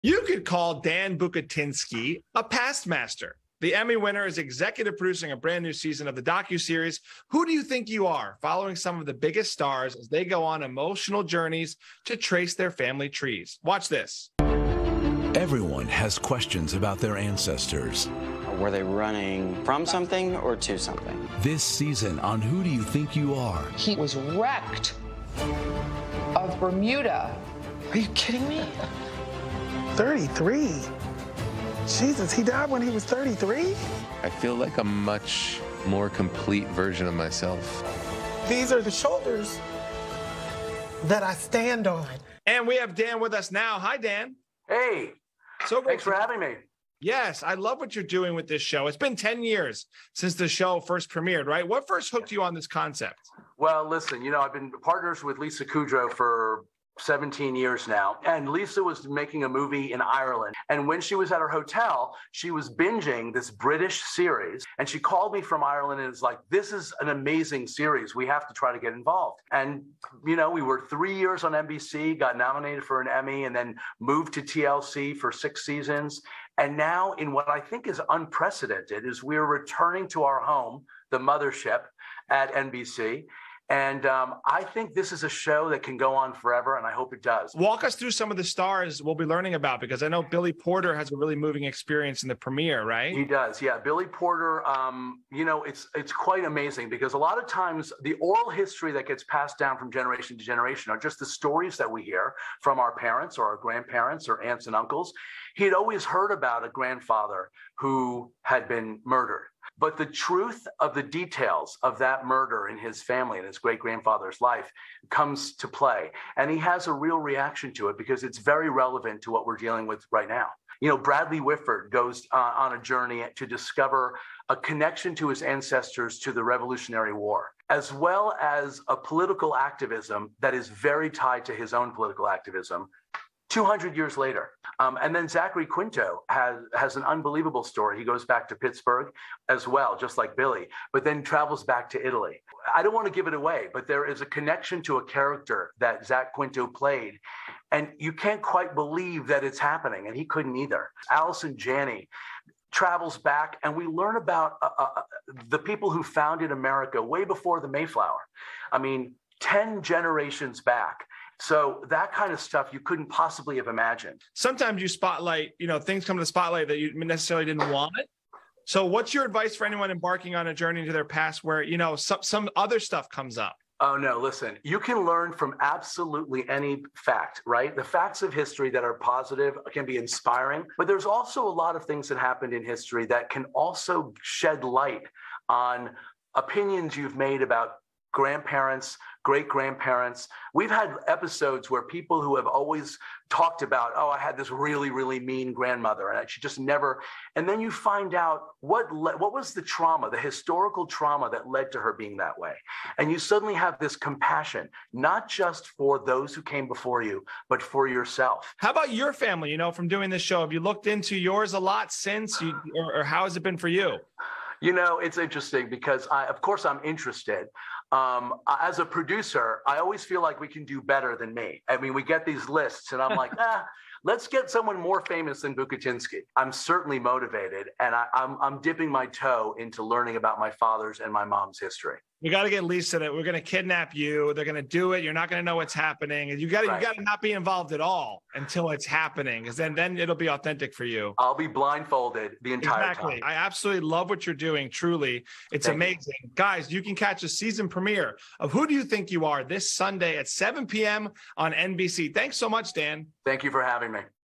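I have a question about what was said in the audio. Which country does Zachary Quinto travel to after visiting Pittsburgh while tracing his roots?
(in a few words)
Italy.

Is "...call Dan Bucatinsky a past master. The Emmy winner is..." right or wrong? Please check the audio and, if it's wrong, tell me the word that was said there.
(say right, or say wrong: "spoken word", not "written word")
right.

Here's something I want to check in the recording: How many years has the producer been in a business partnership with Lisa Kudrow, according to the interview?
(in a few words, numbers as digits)
17.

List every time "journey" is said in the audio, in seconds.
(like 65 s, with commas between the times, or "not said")
11 s, 122 s, 170 s.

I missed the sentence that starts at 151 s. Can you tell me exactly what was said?
Allison Janney travels back, and we learn about uh, uh, the people who founded America way before the Mayflower.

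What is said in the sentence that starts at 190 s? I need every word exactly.
We've had episodes where people who have always talked about, oh, I had this really, really mean grandmother, and she just never.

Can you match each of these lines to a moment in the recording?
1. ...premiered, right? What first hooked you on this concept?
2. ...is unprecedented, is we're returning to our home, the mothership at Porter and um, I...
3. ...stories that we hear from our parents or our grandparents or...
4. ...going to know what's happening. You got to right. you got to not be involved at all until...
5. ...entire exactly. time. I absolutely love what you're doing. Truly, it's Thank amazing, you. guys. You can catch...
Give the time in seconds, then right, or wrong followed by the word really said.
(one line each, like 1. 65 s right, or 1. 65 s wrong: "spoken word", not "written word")
1. 51 s right
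2. 77 s wrong: "NBC", not "Porter"
3. 101 s right
4. 235 s right
5. 242 s right.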